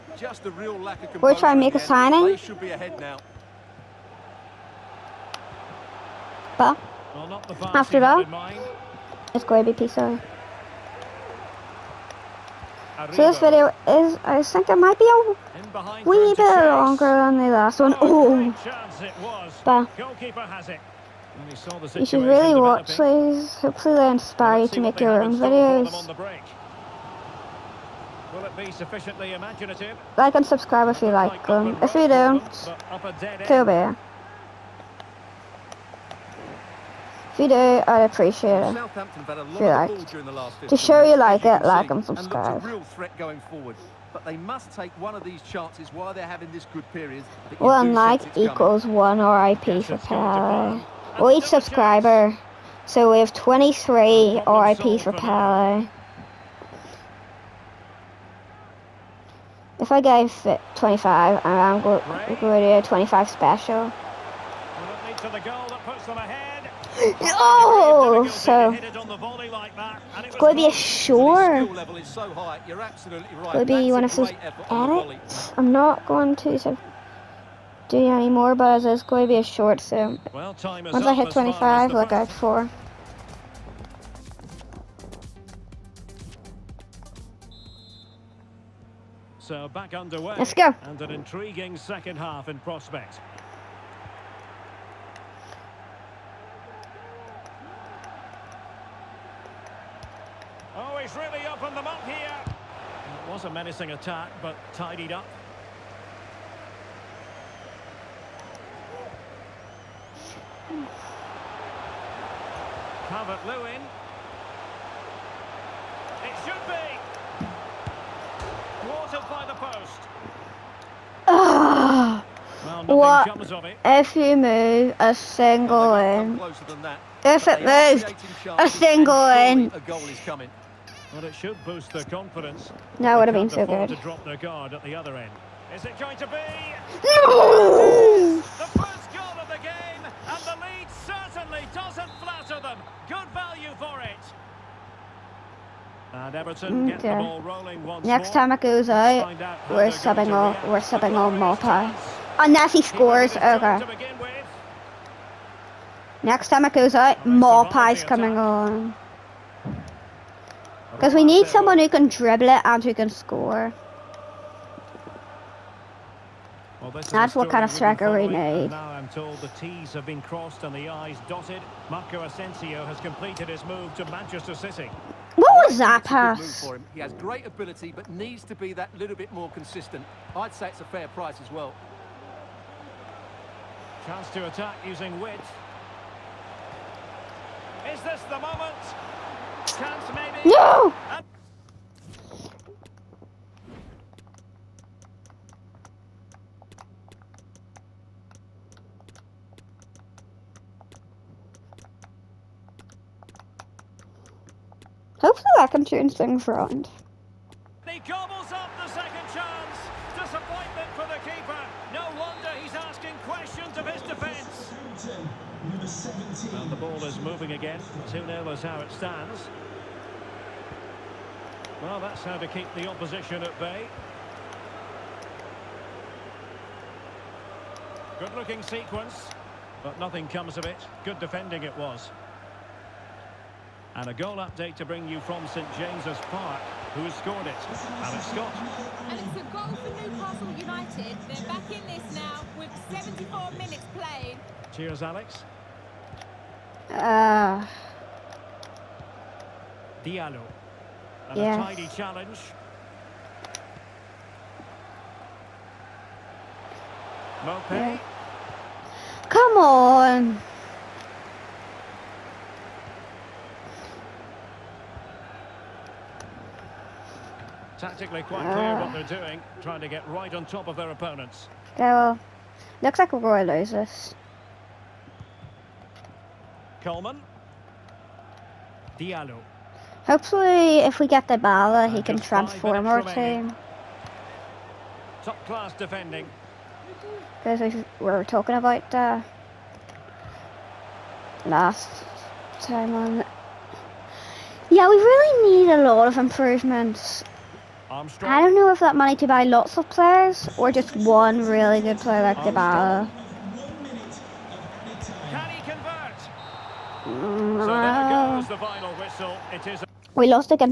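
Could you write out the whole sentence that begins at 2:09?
Well, it should boost their confidence.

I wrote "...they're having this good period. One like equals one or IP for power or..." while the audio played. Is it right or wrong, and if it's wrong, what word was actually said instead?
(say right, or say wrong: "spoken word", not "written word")
right.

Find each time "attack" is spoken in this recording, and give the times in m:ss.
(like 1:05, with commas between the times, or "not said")
1:43, 3:04.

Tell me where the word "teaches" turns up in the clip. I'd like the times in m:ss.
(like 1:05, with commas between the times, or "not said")
not said.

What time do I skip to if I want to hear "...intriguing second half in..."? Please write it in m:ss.
1:31.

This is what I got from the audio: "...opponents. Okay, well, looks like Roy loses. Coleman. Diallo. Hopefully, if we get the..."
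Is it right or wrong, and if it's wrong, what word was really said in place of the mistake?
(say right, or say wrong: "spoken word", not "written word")
right.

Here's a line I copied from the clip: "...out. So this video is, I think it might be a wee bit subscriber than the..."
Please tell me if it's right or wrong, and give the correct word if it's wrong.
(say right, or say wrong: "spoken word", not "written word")
wrong: "longer", not "subscriber".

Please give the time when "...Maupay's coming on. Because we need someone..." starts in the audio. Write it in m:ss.
2:37.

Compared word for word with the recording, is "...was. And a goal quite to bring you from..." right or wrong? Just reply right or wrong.
wrong.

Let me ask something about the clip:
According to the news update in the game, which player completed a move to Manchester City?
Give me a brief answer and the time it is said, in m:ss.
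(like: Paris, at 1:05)
Marco Asensio, at 2:51.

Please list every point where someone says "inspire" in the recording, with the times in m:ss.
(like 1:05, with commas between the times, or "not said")
0:24.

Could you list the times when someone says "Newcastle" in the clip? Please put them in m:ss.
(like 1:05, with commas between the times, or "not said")
4:00.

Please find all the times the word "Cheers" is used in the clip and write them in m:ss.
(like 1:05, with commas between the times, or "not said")
4:04.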